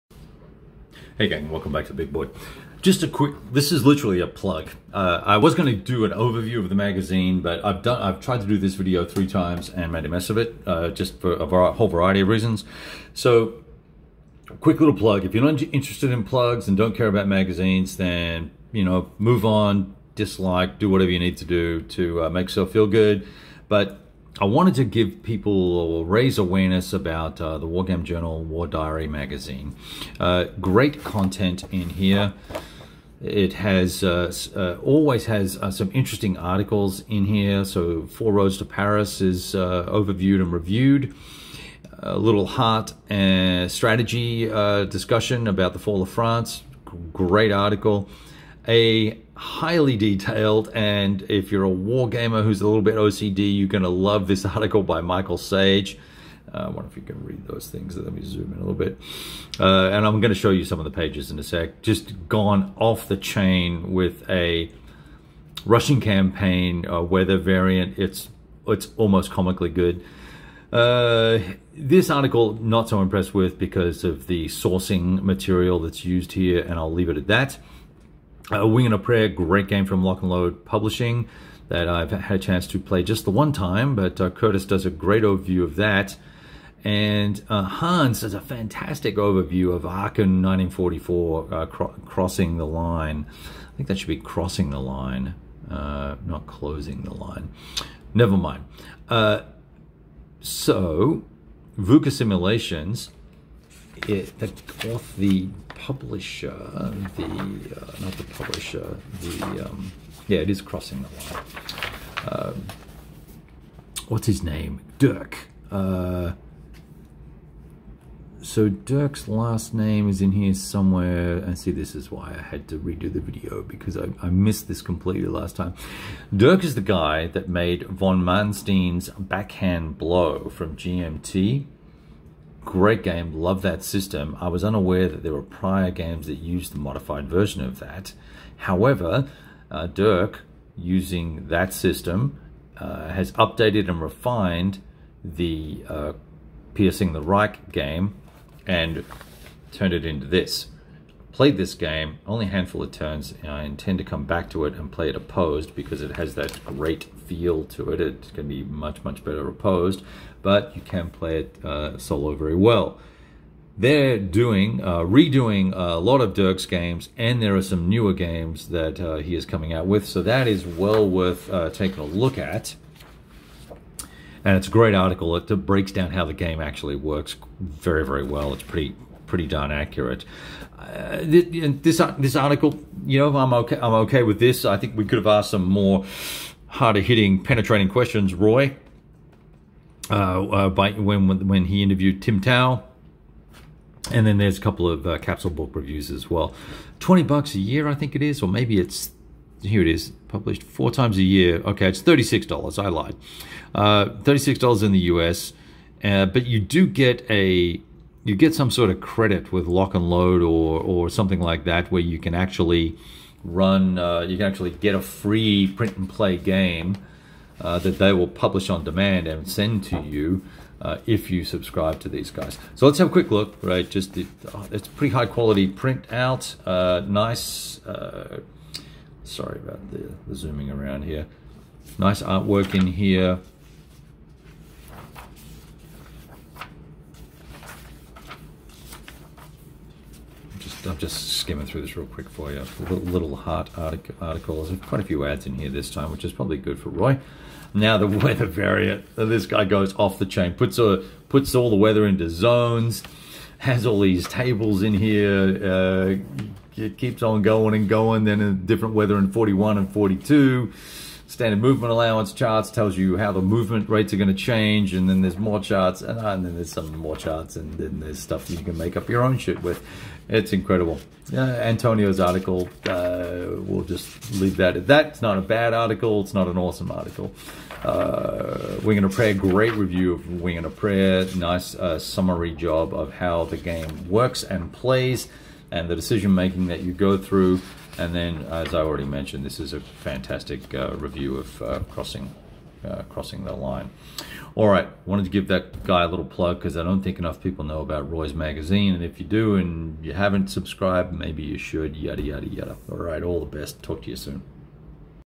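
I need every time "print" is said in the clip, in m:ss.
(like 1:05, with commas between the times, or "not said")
3:35, 3:45.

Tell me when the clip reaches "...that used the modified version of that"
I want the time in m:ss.
2:16.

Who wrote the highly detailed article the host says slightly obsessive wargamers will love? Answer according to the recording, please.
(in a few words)
Michael Sage.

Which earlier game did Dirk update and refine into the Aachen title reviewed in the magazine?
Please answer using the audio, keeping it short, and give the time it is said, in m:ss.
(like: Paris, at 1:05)
Piercing the Reich, at 2:26.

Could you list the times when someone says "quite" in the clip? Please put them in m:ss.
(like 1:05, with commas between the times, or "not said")
4:04.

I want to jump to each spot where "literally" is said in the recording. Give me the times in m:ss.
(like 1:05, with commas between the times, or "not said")
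0:03.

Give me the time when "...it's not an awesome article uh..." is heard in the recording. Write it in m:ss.
4:36.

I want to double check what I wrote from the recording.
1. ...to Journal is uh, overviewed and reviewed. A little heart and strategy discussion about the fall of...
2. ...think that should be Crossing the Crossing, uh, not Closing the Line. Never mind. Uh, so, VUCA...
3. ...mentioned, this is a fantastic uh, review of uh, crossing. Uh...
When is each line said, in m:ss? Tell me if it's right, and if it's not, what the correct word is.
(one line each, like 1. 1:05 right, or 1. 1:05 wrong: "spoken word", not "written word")
1. 0:38 wrong: "Paris", not "Journal"
2. 1:33 wrong: "Line", not "Crossing"
3. 4:49 right.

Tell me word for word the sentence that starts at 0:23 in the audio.
But I wanted to give people or raise awareness about uh, the Wargame Journal War Diary magazine.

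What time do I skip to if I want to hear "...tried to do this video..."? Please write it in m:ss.
0:08.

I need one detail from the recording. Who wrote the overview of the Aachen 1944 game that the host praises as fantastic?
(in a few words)
Hans.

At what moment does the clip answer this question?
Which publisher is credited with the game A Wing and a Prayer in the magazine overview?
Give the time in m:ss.
1:20.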